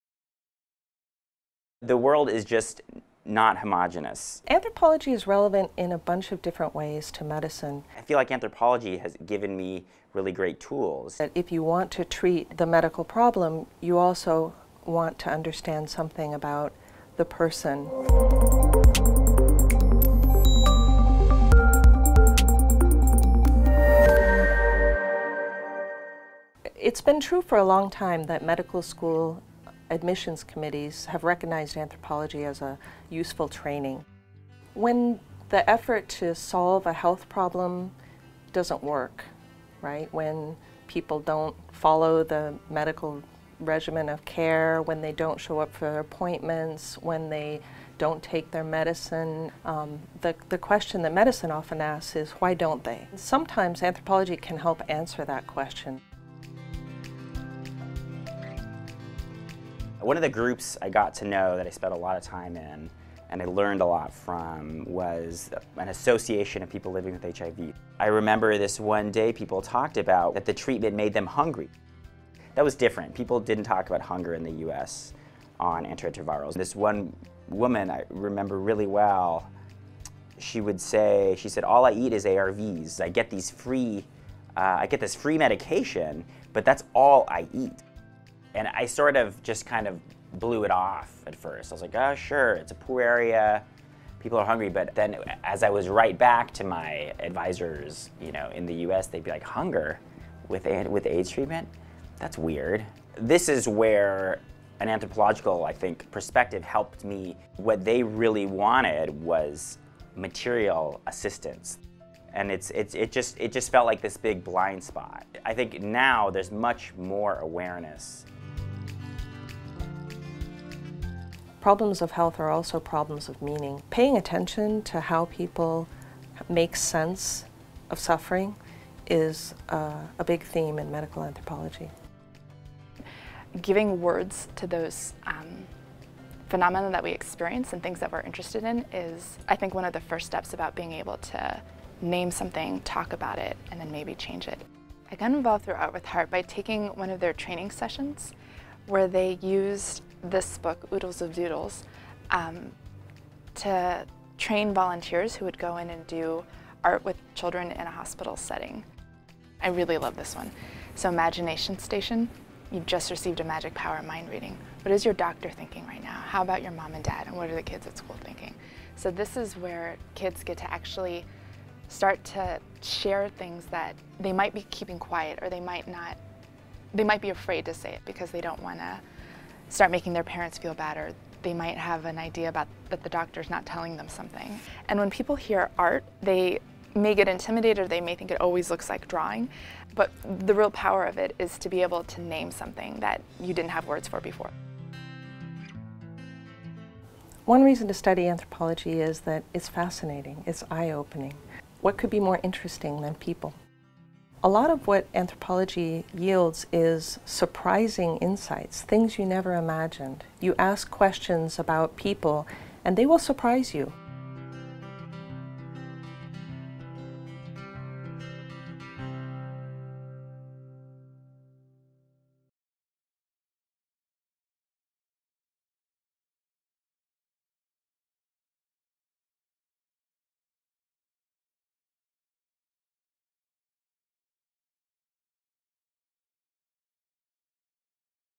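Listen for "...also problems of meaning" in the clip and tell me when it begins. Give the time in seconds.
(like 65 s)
122 s.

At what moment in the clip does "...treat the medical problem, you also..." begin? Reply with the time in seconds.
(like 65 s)
12 s.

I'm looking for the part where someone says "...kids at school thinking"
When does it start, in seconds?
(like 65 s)
167 s.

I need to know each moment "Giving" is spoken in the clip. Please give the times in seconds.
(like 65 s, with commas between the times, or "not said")
133 s.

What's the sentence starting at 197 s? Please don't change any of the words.
One reason to study anthropology is that it's fascinating, it's eye-opening.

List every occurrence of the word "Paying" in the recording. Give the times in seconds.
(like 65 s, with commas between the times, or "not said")
123 s.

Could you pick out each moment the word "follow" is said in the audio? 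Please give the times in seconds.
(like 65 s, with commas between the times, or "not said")
41 s.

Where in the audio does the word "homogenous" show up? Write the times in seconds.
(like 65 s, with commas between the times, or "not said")
3 s.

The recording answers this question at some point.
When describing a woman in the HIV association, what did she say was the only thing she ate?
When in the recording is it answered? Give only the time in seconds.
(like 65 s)
82 s.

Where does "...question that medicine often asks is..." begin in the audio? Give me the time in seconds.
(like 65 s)
50 s.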